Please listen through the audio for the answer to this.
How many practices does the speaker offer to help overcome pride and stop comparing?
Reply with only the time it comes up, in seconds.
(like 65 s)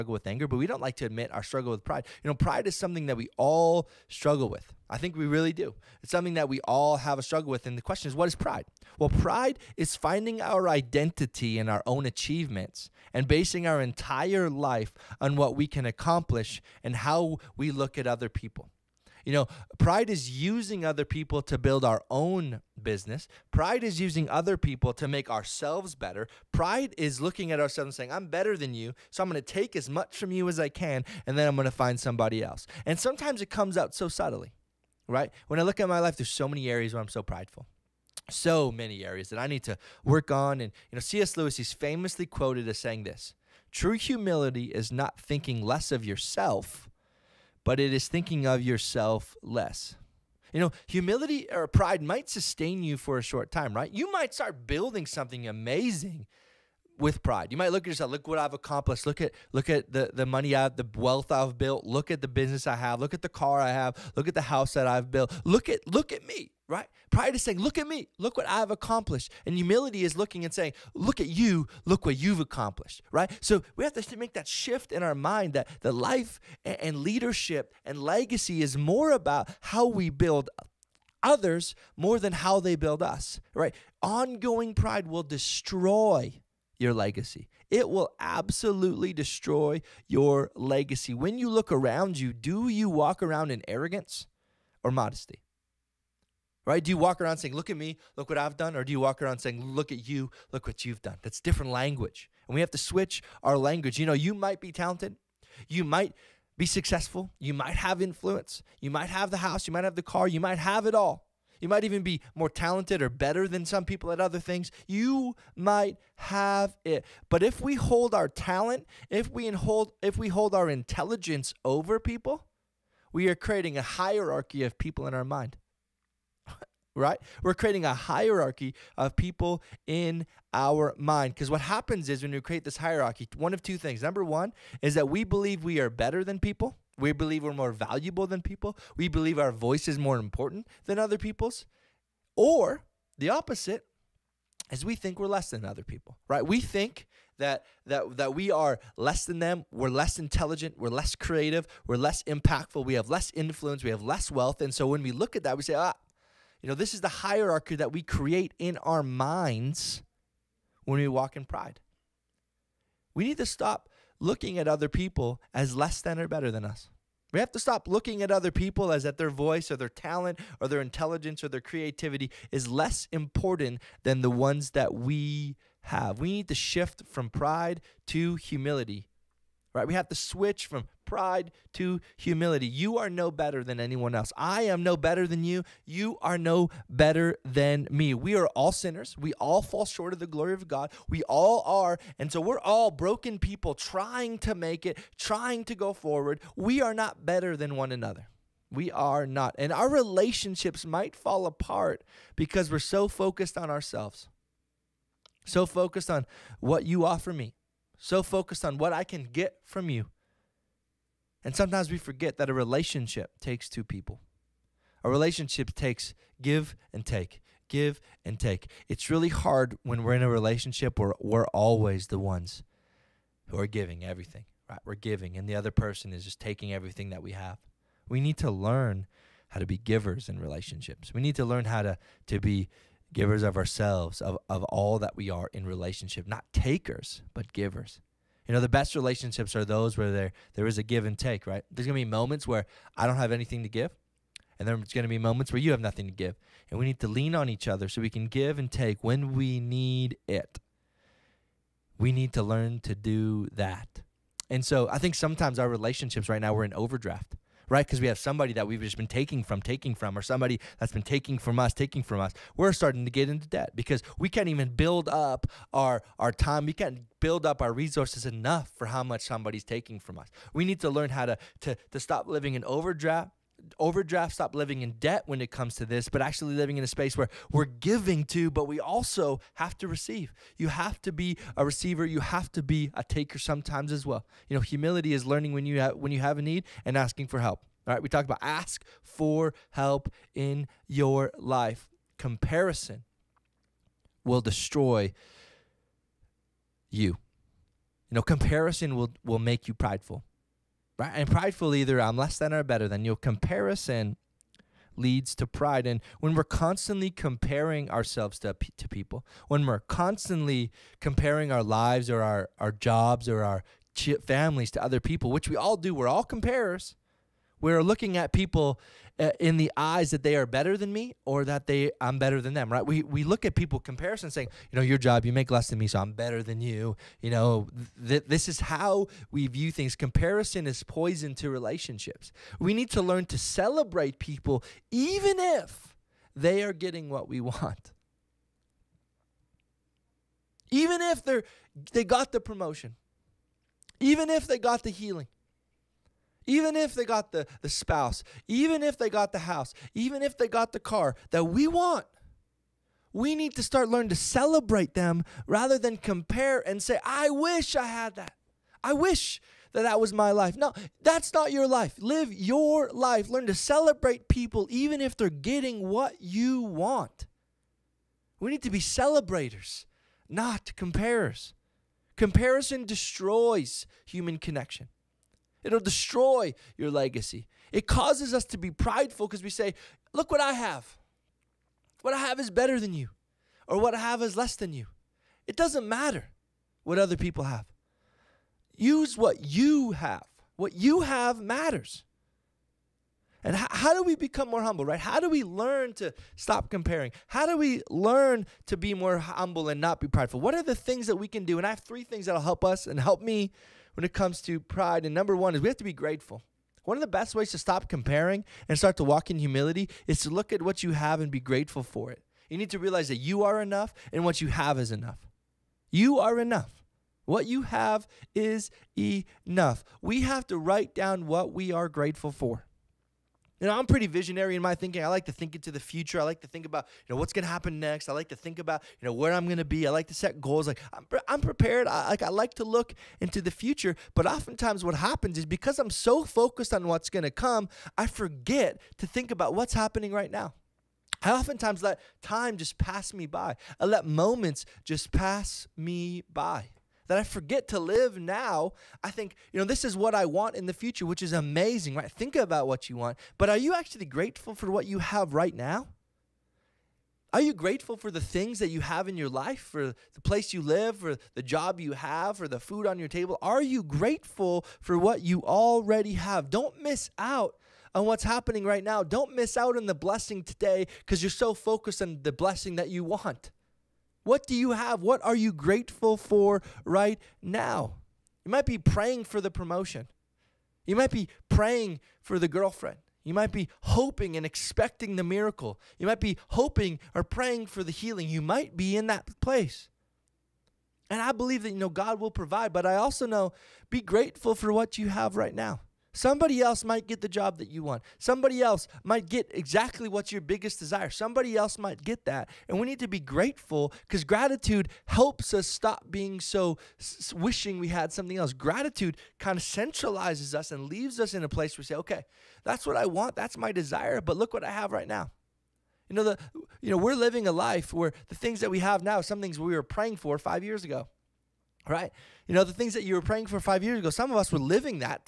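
401 s.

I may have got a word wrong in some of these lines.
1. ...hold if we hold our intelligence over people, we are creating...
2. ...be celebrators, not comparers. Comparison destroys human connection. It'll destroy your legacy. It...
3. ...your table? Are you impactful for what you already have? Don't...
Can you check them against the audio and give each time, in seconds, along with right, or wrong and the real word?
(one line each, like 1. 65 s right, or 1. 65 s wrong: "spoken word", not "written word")
1. 119 s right
2. 368 s right
3. 462 s wrong: "grateful", not "impactful".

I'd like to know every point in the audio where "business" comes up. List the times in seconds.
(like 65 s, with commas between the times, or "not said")
22 s, 62 s.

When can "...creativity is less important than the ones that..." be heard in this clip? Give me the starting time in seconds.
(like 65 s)
171 s.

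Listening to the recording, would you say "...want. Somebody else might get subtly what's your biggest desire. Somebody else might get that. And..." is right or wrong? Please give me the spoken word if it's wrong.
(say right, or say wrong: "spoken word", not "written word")
wrong: "exactly", not "subtly".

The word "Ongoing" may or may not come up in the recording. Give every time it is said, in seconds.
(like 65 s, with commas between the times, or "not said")
84 s.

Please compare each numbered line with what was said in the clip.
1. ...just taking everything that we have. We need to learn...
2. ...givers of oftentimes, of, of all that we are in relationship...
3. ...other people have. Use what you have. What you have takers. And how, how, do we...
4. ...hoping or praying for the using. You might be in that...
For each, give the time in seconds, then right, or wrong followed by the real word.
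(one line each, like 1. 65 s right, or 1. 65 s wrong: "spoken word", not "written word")
1. 226 s right
2. 233 s wrong: "ourselves", not "oftentimes"
3. 386 s wrong: "matters", not "takers"
4. 486 s wrong: "healing", not "using".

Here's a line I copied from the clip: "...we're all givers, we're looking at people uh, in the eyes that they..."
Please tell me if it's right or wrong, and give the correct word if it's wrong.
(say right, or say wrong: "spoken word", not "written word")
wrong: "comparers", not "givers".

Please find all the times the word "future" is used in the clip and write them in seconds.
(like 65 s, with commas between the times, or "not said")
425 s, 433 s, 450 s.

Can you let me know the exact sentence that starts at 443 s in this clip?
I let moments just pass me by that I forget to live now.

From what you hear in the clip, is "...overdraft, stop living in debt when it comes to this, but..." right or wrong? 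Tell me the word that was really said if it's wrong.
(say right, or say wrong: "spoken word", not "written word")
right.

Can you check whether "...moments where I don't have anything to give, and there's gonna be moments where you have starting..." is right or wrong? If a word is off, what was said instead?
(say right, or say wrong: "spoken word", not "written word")
wrong: "nothing", not "starting".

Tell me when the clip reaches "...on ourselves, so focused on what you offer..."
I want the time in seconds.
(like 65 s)
203 s.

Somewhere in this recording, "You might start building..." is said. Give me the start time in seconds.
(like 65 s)
53 s.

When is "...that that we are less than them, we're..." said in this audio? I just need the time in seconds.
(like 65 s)
147 s.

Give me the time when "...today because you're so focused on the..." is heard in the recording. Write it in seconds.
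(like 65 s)
470 s.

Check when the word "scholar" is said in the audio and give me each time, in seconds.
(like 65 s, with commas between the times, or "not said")
not said.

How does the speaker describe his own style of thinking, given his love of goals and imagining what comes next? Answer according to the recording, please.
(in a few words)
visionary.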